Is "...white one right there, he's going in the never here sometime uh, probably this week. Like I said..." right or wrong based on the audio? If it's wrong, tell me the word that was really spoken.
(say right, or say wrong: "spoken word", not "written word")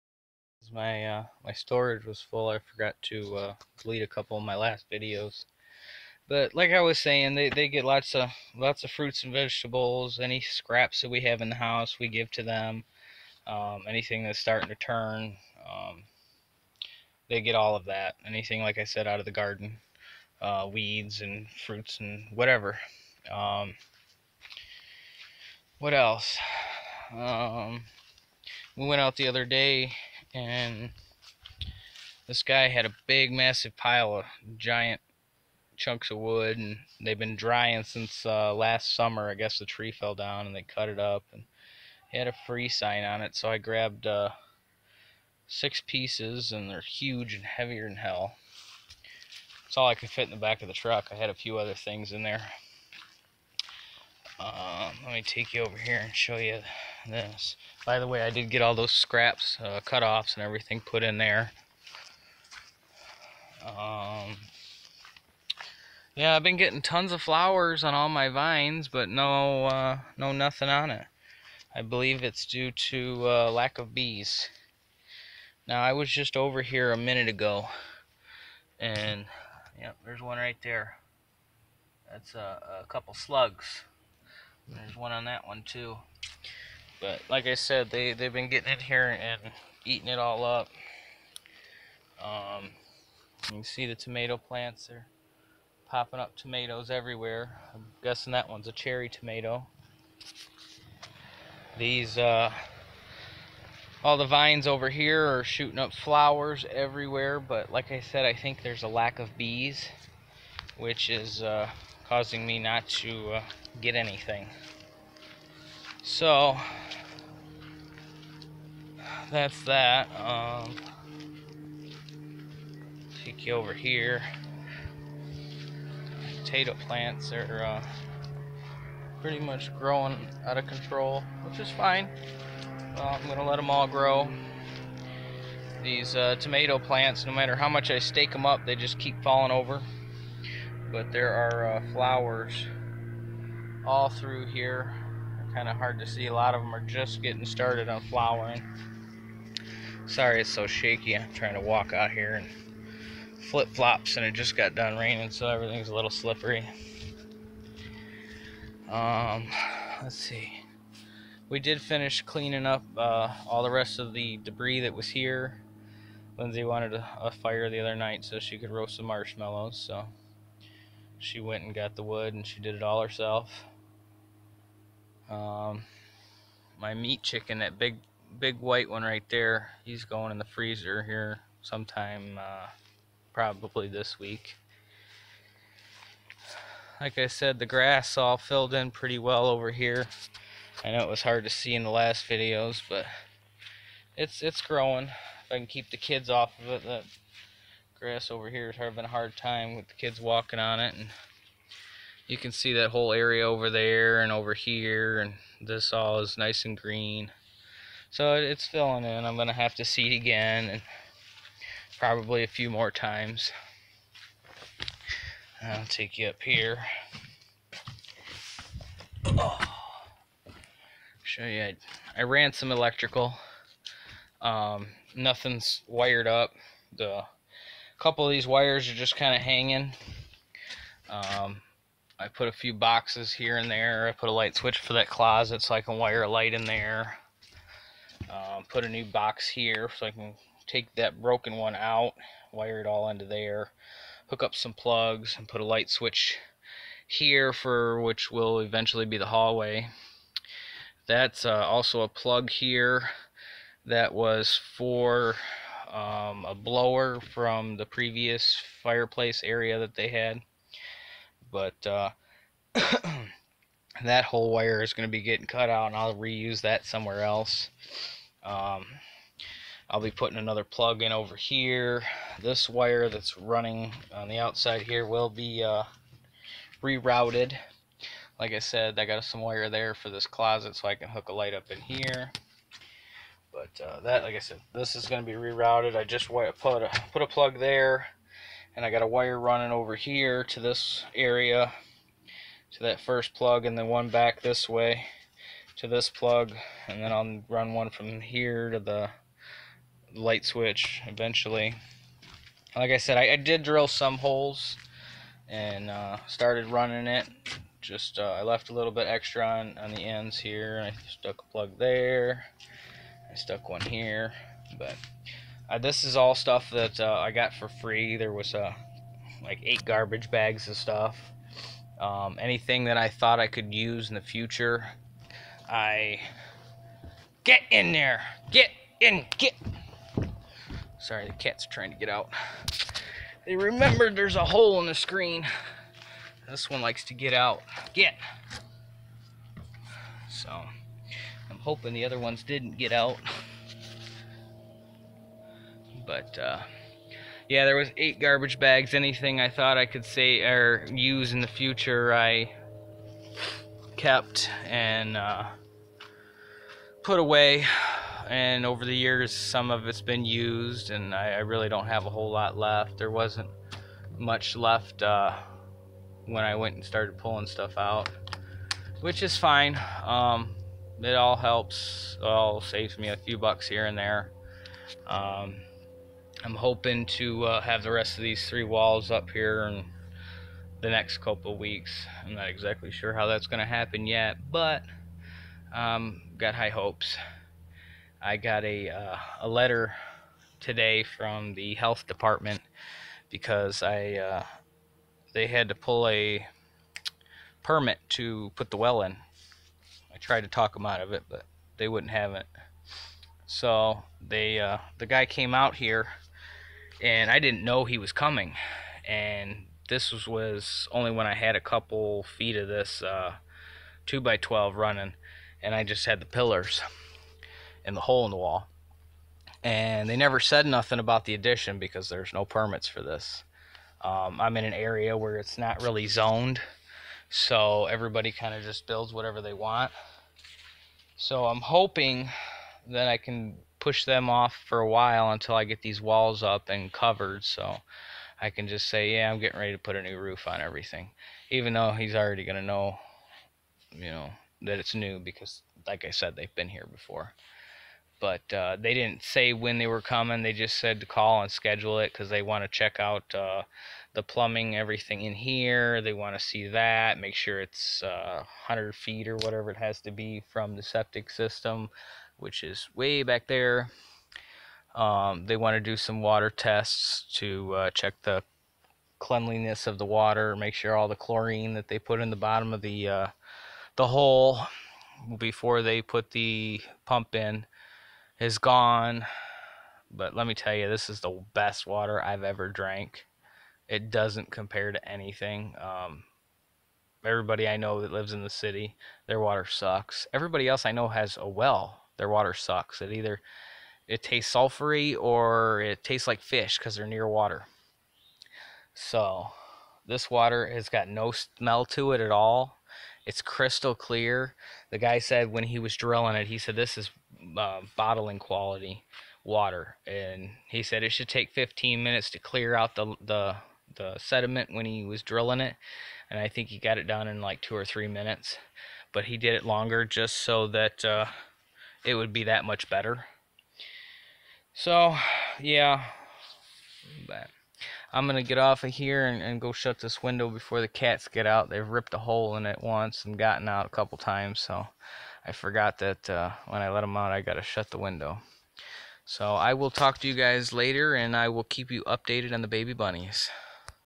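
wrong: "freezer", not "never".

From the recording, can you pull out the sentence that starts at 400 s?
I tried to talk them out of it, but they wouldn't have it.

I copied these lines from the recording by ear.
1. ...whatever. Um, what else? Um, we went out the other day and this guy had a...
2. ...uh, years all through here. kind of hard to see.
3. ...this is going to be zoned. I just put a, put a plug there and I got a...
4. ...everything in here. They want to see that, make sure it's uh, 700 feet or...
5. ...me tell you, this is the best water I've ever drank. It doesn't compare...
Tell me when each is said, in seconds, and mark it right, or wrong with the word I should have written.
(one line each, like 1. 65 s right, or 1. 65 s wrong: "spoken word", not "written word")
1. 22 s right
2. 141 s wrong: "flowers", not "years"
3. 284 s wrong: "rerouted", not "zoned"
4. 454 s wrong: "100", not "700"
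5. 480 s right.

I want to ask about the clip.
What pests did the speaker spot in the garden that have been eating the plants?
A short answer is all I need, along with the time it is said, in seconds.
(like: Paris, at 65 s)
slugs, at 82 s.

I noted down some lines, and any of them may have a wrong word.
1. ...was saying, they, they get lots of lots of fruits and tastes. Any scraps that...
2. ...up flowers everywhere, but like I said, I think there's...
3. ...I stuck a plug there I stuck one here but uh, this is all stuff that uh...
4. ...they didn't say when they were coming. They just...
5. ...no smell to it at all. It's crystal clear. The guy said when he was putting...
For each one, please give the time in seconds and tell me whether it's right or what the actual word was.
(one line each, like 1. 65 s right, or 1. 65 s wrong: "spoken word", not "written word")
1. 6 s wrong: "vegetables", not "tastes"
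2. 105 s right
3. 310 s right
4. 448 s right
5. 501 s wrong: "drilling", not "putting".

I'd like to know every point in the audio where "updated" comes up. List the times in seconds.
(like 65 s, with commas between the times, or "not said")
542 s.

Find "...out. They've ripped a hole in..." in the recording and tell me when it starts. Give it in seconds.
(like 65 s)
531 s.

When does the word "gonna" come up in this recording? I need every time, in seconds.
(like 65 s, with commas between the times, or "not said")
209 s.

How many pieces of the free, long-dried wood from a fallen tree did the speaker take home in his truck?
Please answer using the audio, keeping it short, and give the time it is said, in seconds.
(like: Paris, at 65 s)
6, at 45 s.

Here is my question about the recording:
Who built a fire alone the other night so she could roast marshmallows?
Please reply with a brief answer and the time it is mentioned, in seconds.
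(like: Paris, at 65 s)
Lindsay, at 166 s.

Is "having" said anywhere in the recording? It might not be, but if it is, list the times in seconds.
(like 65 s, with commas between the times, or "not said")
198 s.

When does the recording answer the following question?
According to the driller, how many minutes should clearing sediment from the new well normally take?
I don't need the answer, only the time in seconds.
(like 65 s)
511 s.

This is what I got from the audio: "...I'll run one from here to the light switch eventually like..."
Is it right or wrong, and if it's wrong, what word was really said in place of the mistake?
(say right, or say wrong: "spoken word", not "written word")
right.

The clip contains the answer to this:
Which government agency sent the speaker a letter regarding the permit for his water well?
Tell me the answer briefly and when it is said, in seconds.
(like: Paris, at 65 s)
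health department, at 391 s.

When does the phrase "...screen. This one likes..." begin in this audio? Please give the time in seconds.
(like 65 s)
334 s.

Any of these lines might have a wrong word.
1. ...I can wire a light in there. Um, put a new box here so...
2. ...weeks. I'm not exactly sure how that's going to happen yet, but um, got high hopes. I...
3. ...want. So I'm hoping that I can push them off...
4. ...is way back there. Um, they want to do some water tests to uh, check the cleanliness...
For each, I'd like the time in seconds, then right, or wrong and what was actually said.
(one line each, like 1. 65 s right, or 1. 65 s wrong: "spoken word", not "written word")
1. 235 s right
2. 381 s right
3. 429 s right
4. 462 s right.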